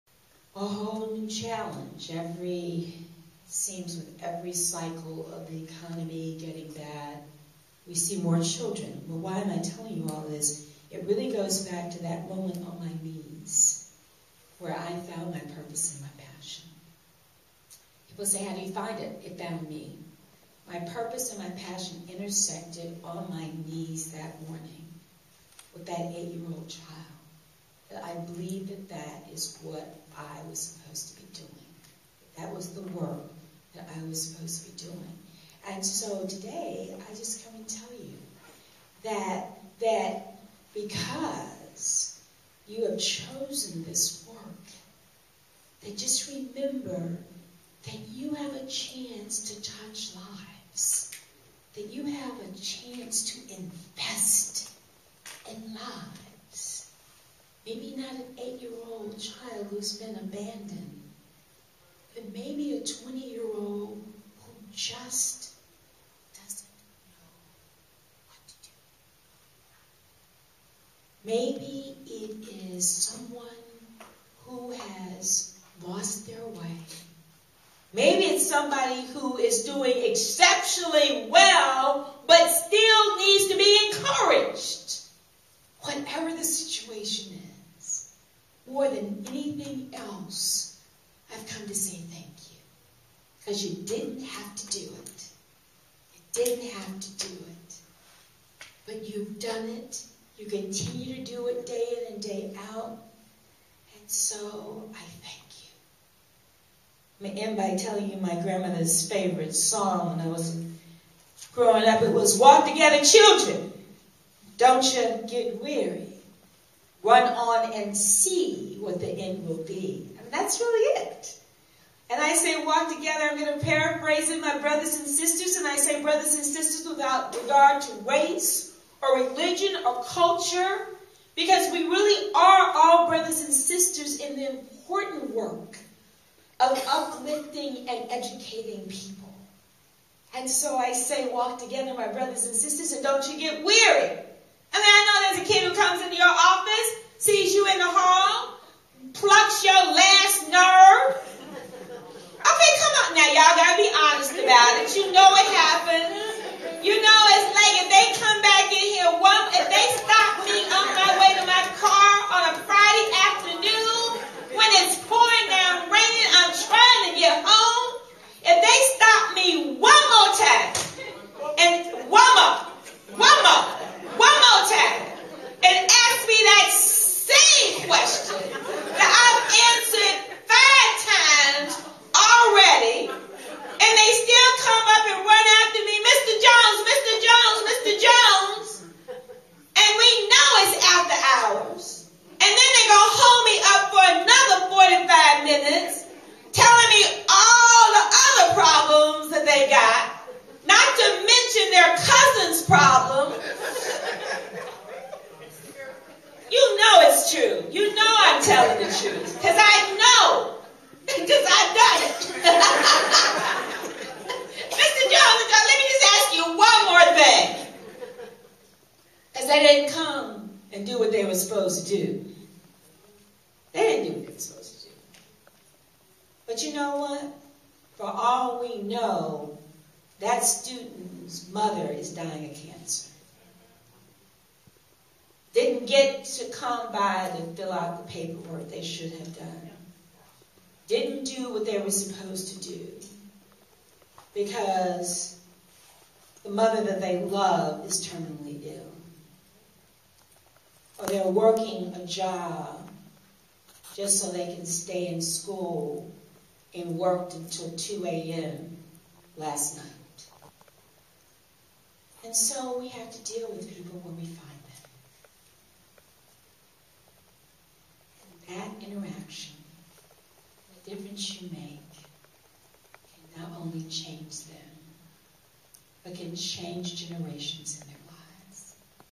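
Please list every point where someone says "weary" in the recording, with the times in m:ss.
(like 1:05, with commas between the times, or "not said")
1:55, 2:23.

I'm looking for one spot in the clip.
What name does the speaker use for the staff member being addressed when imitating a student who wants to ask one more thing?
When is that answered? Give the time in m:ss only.
3:34.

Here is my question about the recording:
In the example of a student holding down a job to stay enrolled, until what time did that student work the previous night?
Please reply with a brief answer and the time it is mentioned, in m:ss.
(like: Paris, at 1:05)
2 a.m., at 4:17.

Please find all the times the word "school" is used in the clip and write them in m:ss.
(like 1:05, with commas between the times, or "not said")
4:15.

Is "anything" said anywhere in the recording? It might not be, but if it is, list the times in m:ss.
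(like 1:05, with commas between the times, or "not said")
1:29.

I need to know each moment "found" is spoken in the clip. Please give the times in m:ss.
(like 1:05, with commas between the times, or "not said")
0:15, 0:19.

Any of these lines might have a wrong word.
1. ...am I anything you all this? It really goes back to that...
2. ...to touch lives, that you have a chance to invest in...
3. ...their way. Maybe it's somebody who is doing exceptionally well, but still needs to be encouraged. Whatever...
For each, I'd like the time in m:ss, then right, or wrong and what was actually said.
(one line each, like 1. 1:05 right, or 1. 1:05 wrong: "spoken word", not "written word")
1. 0:09 wrong: "telling", not "anything"
2. 0:49 right
3. 1:16 right.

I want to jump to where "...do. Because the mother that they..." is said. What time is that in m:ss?
4:02.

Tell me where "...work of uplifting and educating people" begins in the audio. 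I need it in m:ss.
2:15.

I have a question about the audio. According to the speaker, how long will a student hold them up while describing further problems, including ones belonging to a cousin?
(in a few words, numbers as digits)
45 minutes.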